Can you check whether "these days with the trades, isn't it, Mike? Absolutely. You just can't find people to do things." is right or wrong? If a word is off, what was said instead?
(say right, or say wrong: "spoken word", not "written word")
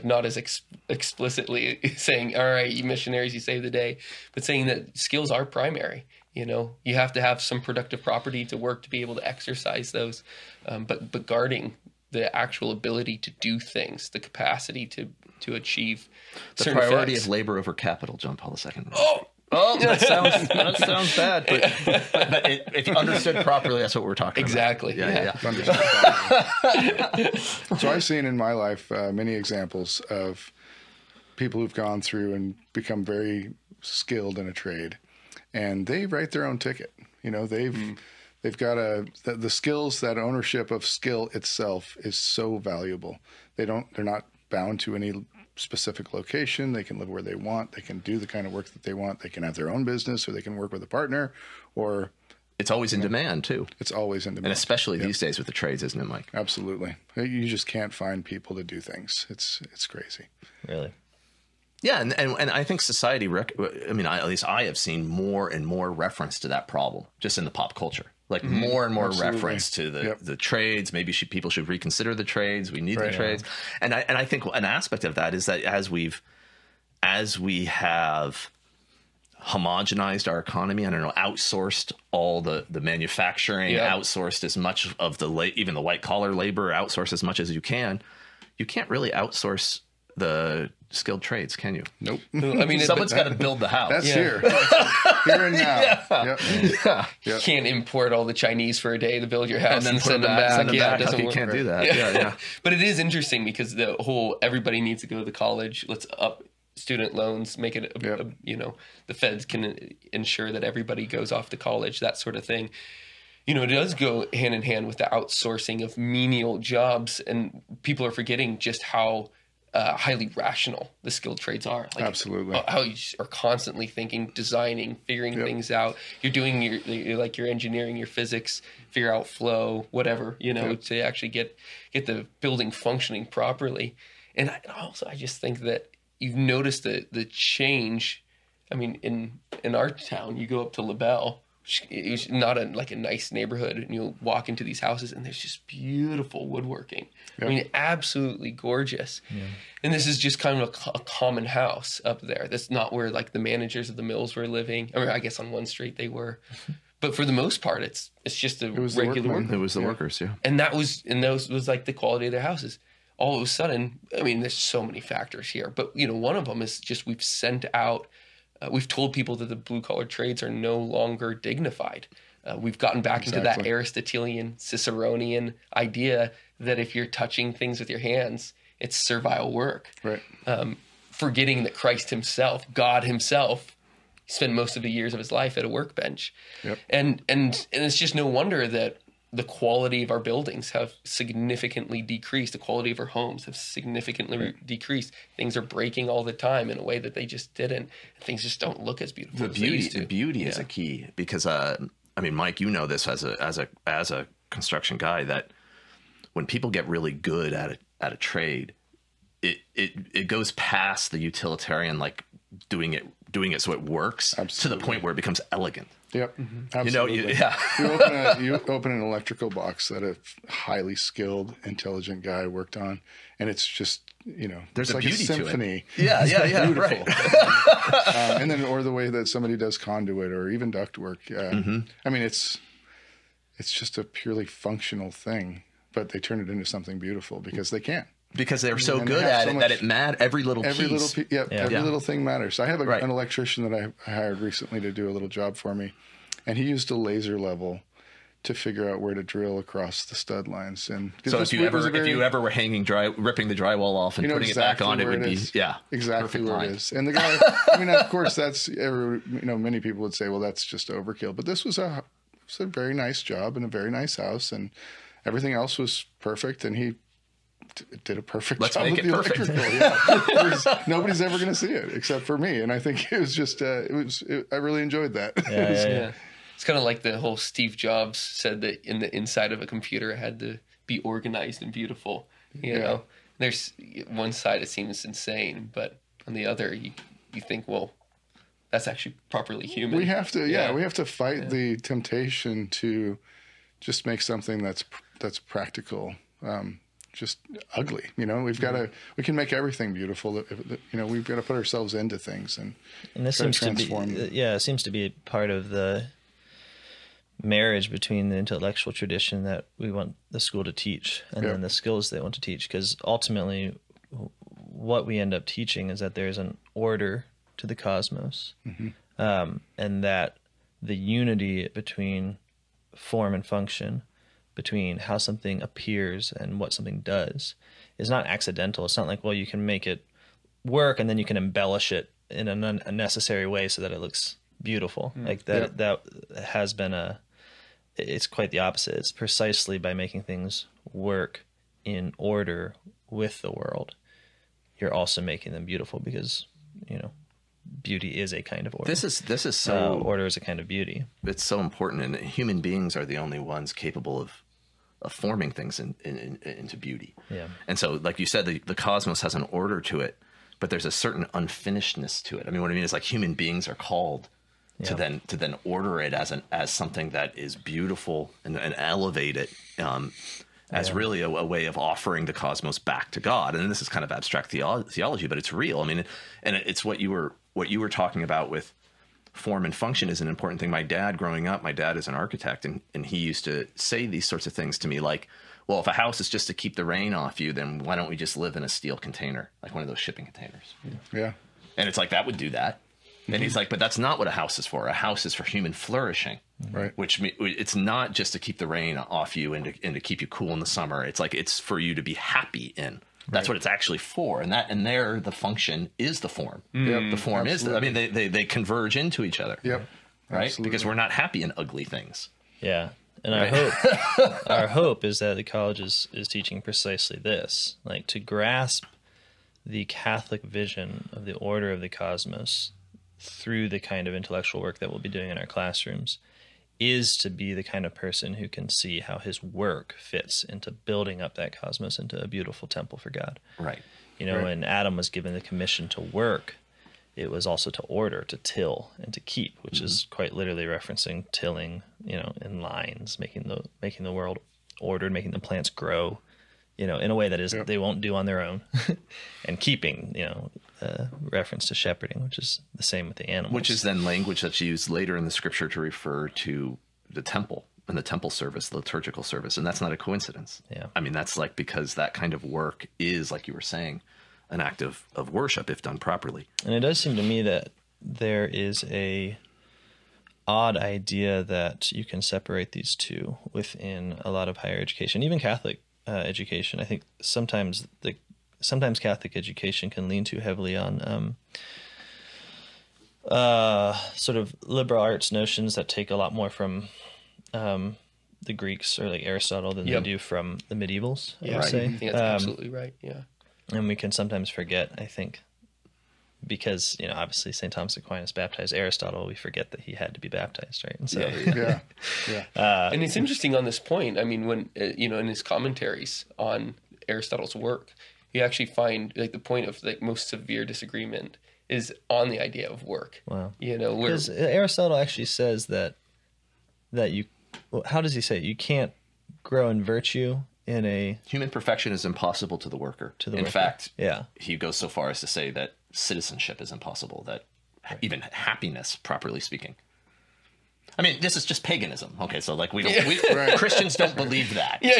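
right.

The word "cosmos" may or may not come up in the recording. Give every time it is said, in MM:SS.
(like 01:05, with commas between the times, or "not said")
05:17, 05:58, 06:12, 07:01, 07:11.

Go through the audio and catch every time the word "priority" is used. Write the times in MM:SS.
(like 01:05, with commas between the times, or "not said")
00:16.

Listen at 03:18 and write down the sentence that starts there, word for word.
Things just don't look as beautiful.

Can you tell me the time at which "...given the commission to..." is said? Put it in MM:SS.
07:15.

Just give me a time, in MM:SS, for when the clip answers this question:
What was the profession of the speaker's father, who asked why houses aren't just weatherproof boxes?
06:22.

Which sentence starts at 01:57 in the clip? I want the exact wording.
And people are forgetting just how uh, highly rational the skilled trades are.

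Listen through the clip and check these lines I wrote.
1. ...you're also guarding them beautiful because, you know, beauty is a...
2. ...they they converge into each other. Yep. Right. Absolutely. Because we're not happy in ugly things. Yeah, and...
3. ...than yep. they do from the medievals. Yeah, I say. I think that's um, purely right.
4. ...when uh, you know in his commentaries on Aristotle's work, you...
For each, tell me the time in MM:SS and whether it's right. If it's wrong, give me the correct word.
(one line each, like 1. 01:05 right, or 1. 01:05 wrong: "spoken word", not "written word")
1. 05:44 wrong: "making", not "guarding"
2. 06:48 right
3. 08:09 wrong: "absolutely", not "purely"
4. 08:24 right.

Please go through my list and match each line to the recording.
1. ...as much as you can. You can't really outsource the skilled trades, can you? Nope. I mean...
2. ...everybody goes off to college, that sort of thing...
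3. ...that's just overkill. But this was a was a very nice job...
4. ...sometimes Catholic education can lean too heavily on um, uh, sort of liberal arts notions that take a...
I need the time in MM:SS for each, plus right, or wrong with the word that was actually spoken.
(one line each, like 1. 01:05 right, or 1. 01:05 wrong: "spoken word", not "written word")
1. 01:27 right
2. 01:50 right
3. 04:20 right
4. 07:58 right.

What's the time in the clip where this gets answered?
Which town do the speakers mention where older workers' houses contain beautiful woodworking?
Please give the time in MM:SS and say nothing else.
02:20.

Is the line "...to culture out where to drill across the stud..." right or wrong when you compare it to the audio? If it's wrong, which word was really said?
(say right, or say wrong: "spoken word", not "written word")
wrong: "figure", not "culture".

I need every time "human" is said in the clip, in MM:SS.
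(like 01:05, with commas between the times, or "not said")
04:49, 05:52, 06:03, 06:35, 08:41.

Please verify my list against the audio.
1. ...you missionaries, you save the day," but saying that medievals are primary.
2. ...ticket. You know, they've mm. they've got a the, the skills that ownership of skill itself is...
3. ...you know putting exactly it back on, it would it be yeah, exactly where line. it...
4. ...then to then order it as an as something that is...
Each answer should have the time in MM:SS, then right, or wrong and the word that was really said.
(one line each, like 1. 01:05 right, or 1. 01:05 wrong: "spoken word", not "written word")
1. 00:02 wrong: "skills", not "medievals"
2. 00:36 right
3. 04:14 right
4. 06:04 right.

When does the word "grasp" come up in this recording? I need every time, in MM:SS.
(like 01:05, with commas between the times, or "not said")
06:58.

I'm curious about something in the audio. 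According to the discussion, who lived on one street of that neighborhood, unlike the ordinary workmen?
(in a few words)
The managers of the mills.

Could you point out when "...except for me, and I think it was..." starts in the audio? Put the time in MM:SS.
04:31.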